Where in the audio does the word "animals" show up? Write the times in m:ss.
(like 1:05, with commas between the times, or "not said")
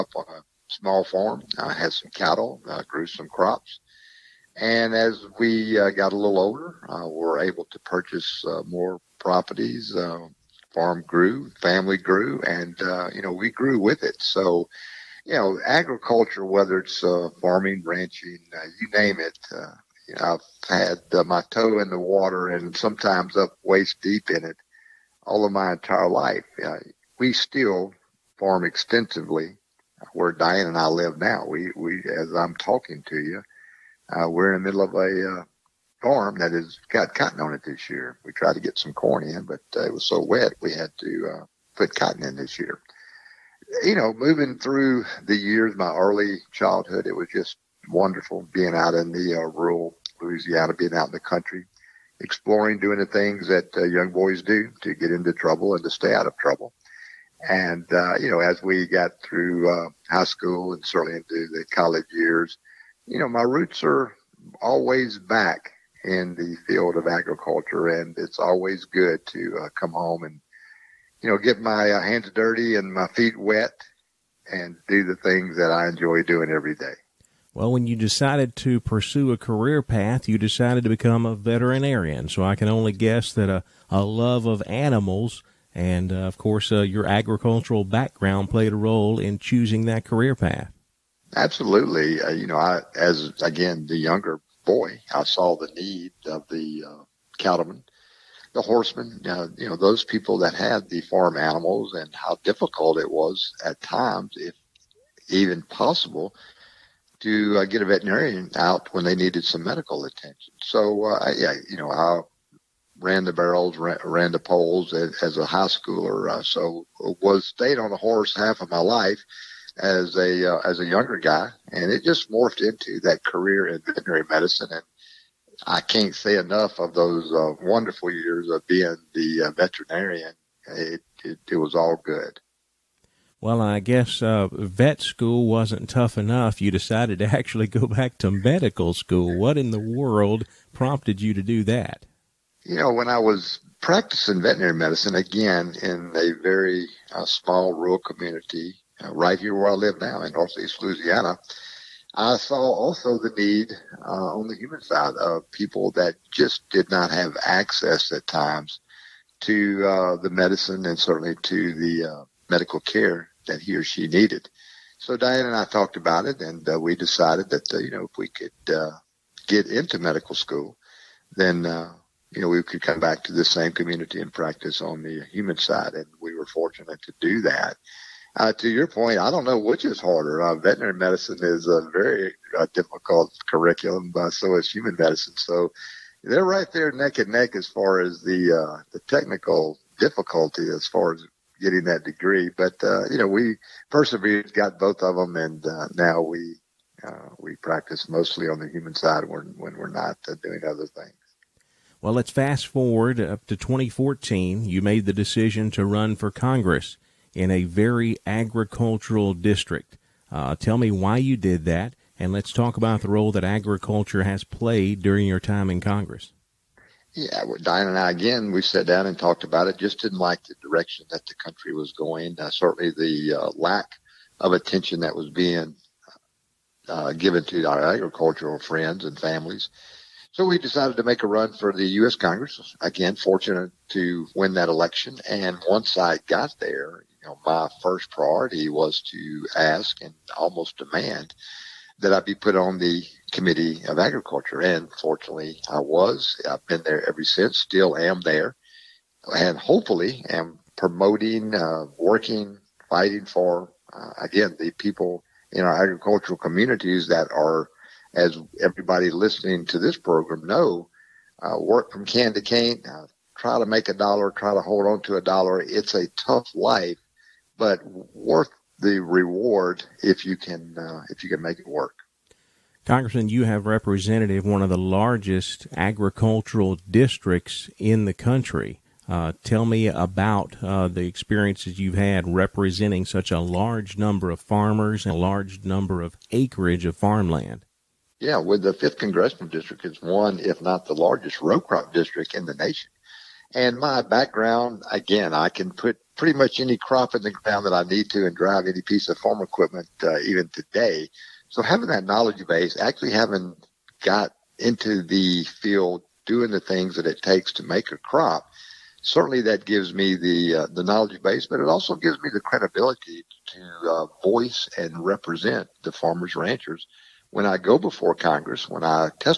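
1:24, 1:41.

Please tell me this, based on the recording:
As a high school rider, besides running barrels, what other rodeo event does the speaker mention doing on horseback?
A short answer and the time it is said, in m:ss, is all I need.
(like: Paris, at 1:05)
Poles, at 1:54.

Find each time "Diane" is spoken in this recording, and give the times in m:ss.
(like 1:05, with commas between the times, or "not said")
0:30, 2:45, 3:37.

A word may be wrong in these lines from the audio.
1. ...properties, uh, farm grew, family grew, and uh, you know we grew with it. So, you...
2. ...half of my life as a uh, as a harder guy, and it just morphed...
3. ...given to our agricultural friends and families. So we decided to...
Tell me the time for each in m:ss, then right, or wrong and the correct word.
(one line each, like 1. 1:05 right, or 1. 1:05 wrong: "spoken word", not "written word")
1. 0:09 right
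2. 1:58 wrong: "younger", not "harder"
3. 3:47 right.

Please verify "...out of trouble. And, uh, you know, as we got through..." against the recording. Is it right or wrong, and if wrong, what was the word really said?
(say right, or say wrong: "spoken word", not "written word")
right.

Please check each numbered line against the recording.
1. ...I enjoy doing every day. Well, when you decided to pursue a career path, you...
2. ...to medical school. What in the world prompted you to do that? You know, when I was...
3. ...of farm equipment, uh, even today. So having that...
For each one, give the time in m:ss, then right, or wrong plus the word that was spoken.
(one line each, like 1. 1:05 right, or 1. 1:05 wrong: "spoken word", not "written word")
1. 1:15 right
2. 2:18 right
3. 4:59 right.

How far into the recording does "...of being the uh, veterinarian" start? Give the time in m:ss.
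2:08.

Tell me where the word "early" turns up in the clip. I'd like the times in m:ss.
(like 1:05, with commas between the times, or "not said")
0:45.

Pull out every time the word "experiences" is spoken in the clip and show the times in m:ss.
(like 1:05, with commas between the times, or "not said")
4:41.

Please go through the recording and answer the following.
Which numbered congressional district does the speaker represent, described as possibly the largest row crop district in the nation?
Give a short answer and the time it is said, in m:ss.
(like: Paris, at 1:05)
Fifth, at 4:48.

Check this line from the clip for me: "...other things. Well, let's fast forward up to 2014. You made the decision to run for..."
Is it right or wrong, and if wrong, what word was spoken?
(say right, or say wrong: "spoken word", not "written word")
right.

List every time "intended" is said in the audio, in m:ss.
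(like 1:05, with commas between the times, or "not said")
not said.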